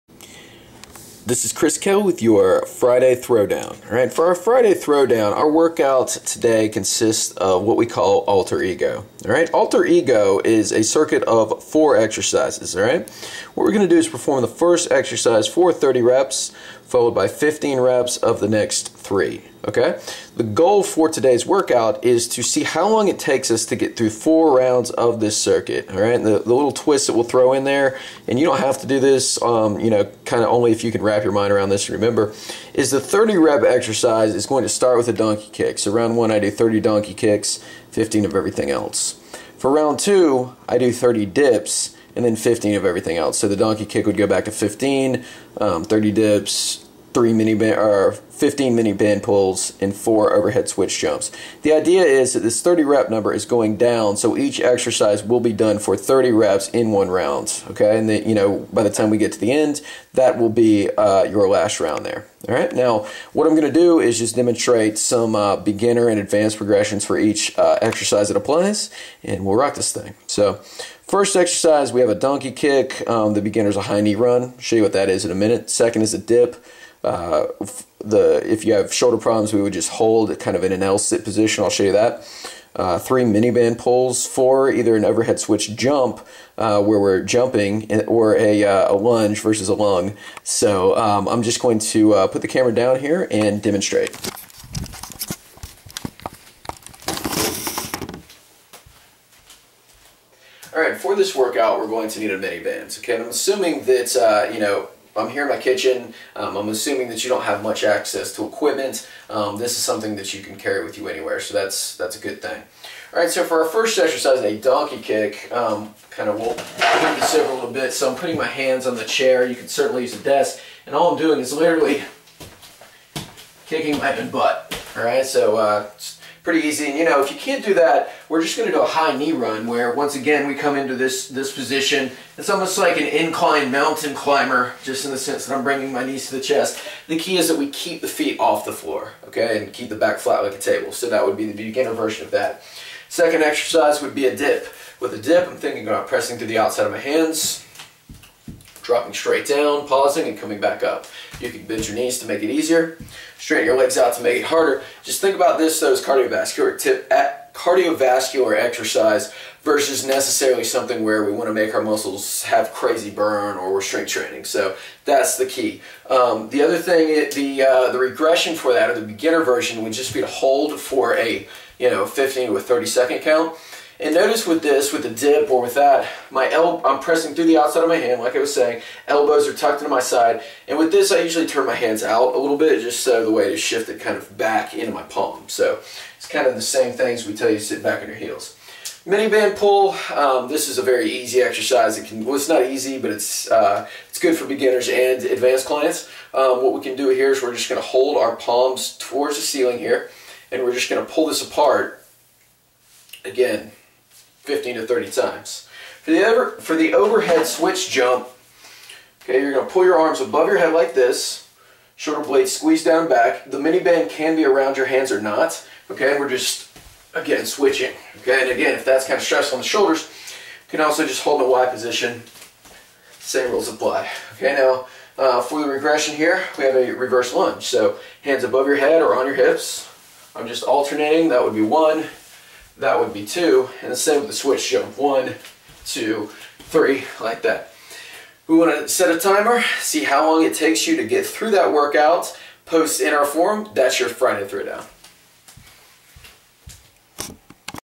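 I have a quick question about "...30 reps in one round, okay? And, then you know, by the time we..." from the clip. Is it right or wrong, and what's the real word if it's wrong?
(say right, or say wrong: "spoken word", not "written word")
right.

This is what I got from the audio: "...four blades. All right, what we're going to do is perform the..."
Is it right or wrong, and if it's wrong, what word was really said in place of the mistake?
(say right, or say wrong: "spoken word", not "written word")
wrong: "exercises", not "blades".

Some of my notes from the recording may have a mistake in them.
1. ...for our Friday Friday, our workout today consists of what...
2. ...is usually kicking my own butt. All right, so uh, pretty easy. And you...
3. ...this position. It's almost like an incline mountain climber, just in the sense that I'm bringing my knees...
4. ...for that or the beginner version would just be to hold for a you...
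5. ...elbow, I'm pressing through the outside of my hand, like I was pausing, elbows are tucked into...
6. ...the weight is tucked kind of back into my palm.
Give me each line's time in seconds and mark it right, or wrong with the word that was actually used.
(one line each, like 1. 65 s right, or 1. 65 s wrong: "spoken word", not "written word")
1. 4 s wrong: "Throwdown", not "Friday"
2. 121 s wrong: "literally", not "usually"
3. 131 s right
4. 168 s right
5. 176 s wrong: "saying", not "pausing"
6. 183 s wrong: "shifted", not "tucked".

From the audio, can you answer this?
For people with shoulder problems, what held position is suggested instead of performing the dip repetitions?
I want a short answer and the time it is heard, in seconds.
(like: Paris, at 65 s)
L sit position, at 80 s.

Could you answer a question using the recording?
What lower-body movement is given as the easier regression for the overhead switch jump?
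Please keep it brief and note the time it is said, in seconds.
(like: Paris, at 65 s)
reverse lunge, at 226 s.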